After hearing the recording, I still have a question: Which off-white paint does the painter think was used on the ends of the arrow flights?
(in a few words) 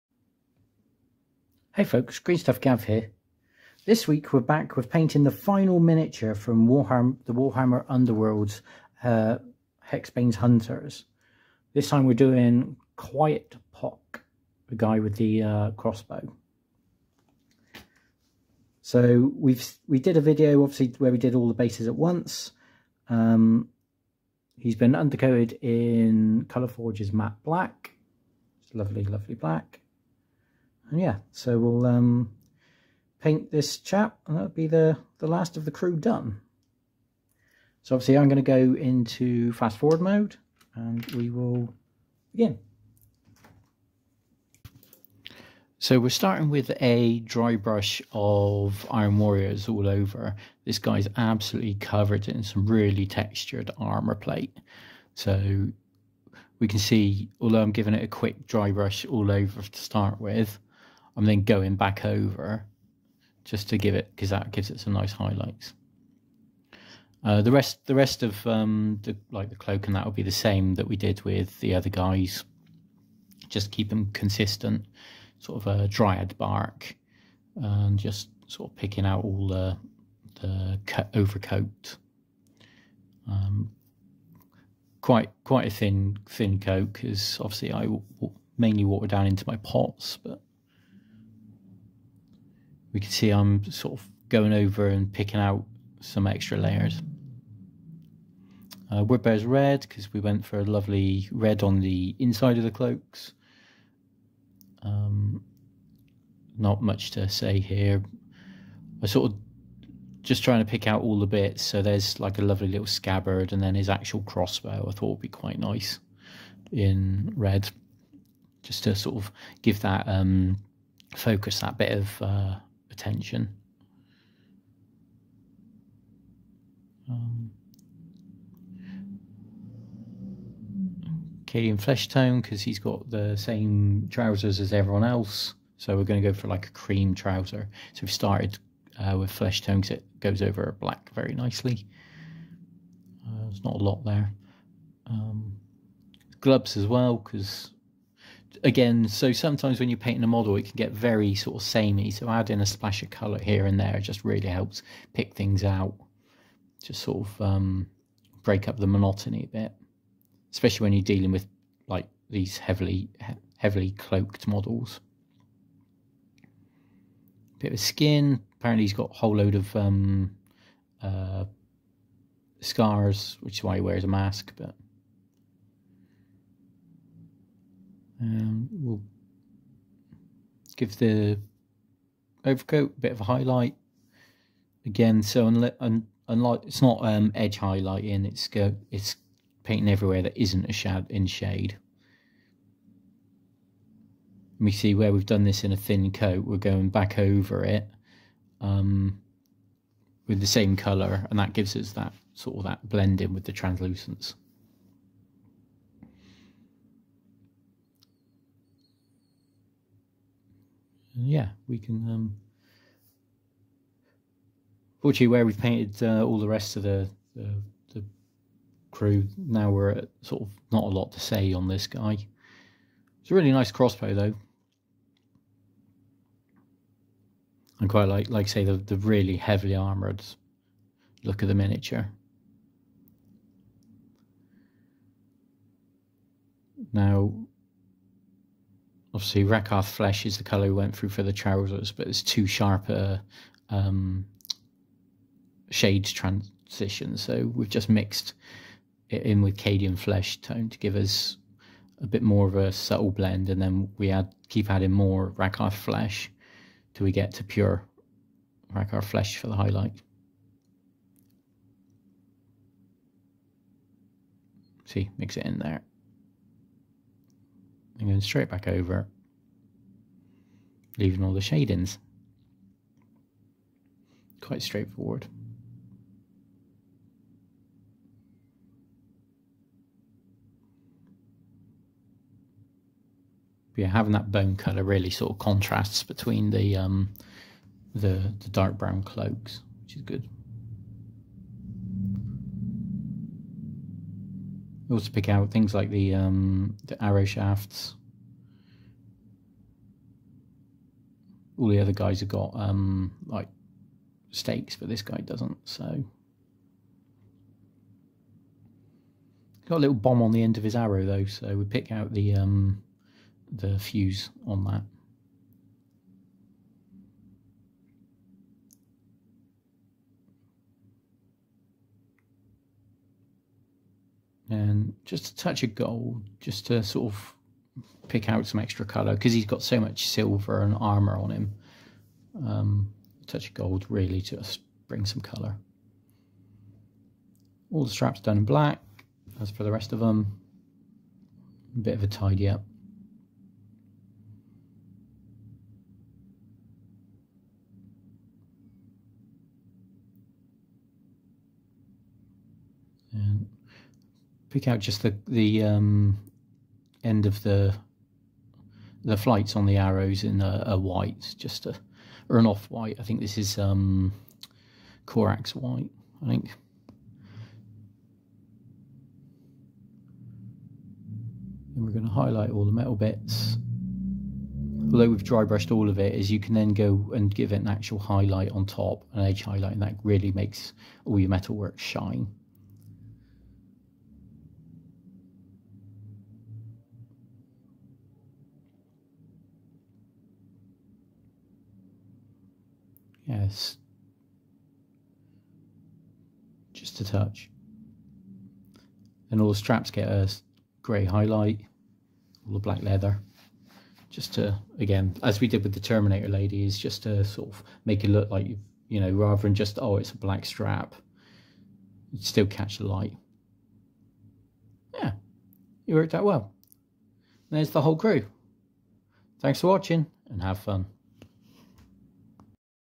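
Corax White.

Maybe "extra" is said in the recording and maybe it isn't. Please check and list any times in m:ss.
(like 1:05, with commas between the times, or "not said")
1:36, 5:28.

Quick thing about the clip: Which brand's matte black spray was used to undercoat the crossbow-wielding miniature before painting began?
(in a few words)
Colour Forge.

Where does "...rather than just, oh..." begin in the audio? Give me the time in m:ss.
6:49.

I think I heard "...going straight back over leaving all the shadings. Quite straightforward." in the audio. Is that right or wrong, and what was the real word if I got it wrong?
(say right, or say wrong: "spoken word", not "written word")
right.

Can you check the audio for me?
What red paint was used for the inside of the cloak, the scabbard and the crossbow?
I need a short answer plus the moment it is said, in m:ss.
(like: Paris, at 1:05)
Wood Bear's Red, at 1:39.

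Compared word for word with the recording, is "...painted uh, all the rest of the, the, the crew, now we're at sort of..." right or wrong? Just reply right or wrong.
right.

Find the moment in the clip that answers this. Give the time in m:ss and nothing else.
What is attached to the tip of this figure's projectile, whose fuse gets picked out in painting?
5:09.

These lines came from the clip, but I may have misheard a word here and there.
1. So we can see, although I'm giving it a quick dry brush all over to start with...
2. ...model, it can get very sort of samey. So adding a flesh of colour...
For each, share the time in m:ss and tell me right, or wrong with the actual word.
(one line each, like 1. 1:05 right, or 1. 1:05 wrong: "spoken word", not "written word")
1. 0:55 right
2. 2:30 wrong: "splash", not "flesh".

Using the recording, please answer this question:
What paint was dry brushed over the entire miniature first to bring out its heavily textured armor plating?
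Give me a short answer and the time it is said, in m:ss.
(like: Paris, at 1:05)
Iron Warriors, at 0:48.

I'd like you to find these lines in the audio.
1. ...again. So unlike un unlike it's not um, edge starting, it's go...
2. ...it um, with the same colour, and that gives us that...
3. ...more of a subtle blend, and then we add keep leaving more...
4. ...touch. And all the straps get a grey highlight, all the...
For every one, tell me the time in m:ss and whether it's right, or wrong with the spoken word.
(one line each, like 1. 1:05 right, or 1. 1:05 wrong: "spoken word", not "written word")
1. 3:04 wrong: "highlighting", not "starting"
2. 3:17 right
3. 4:12 wrong: "adding", not "leaving"
4. 6:37 right.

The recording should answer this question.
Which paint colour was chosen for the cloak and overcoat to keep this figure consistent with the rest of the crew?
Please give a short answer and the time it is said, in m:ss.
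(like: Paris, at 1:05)
Dryad Bark, at 1:15.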